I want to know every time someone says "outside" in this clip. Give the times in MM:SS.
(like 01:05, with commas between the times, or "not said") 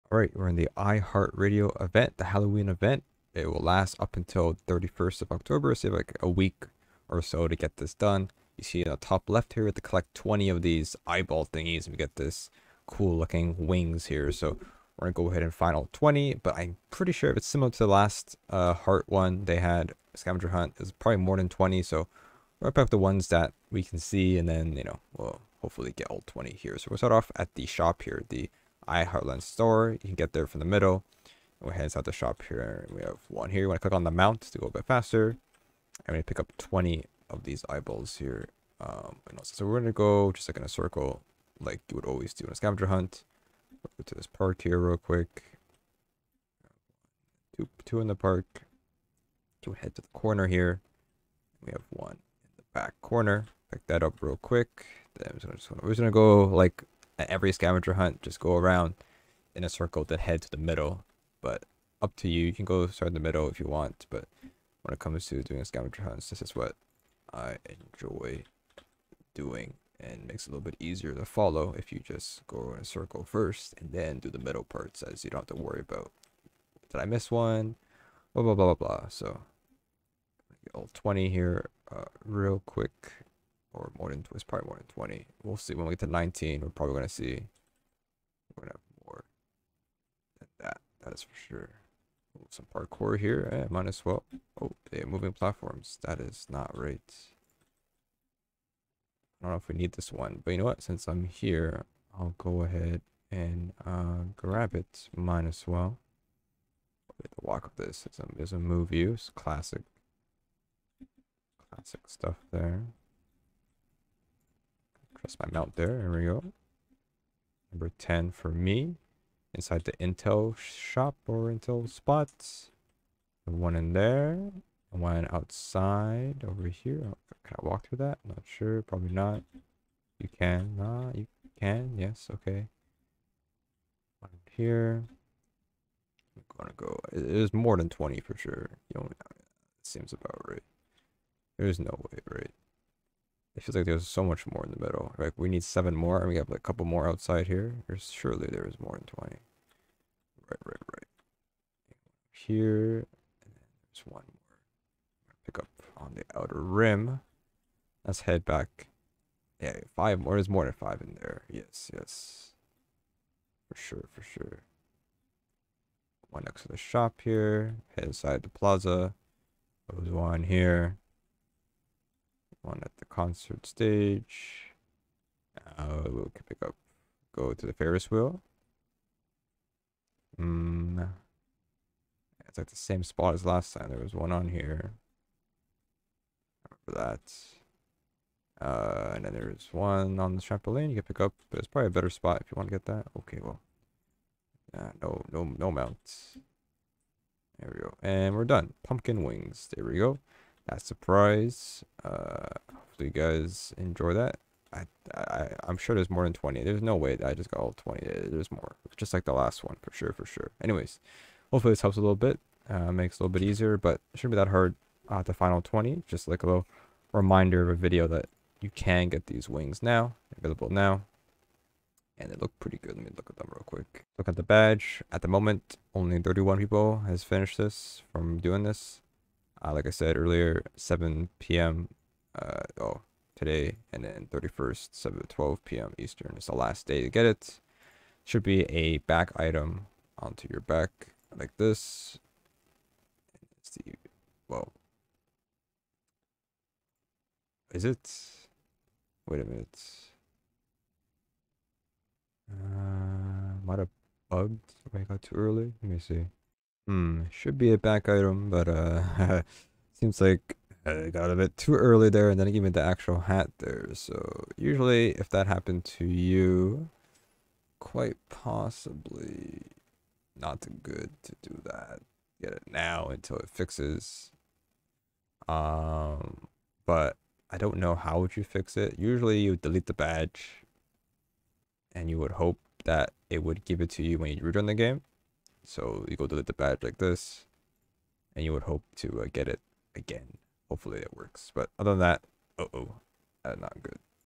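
02:05, 02:27.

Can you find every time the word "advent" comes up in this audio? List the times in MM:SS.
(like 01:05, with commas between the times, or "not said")
not said.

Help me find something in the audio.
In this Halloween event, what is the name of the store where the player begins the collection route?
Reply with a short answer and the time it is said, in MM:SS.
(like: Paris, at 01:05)
Heartland store, at 00:28.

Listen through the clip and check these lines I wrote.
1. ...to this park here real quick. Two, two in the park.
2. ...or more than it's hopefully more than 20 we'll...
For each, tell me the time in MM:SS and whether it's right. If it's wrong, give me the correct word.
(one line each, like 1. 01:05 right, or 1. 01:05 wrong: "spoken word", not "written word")
1. 00:44 right
2. 01:23 wrong: "probably", not "hopefully".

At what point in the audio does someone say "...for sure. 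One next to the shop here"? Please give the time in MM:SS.
02:44.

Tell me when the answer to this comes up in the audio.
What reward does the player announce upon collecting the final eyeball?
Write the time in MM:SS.
03:18.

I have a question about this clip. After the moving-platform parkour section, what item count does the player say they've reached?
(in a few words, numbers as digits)
10.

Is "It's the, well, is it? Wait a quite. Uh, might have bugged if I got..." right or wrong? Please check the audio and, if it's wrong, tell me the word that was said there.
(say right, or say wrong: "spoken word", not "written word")
wrong: "minute", not "quite".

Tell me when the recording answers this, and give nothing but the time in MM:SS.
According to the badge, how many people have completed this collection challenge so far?
03:46.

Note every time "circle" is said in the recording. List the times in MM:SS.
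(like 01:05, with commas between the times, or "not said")
00:40, 00:59, 01:12.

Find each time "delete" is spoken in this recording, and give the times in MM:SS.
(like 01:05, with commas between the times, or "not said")
04:39, 04:46.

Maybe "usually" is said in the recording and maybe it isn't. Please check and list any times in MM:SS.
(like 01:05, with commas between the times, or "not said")
04:24, 04:38.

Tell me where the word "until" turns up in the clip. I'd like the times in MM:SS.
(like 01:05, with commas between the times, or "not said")
00:04, 04:33.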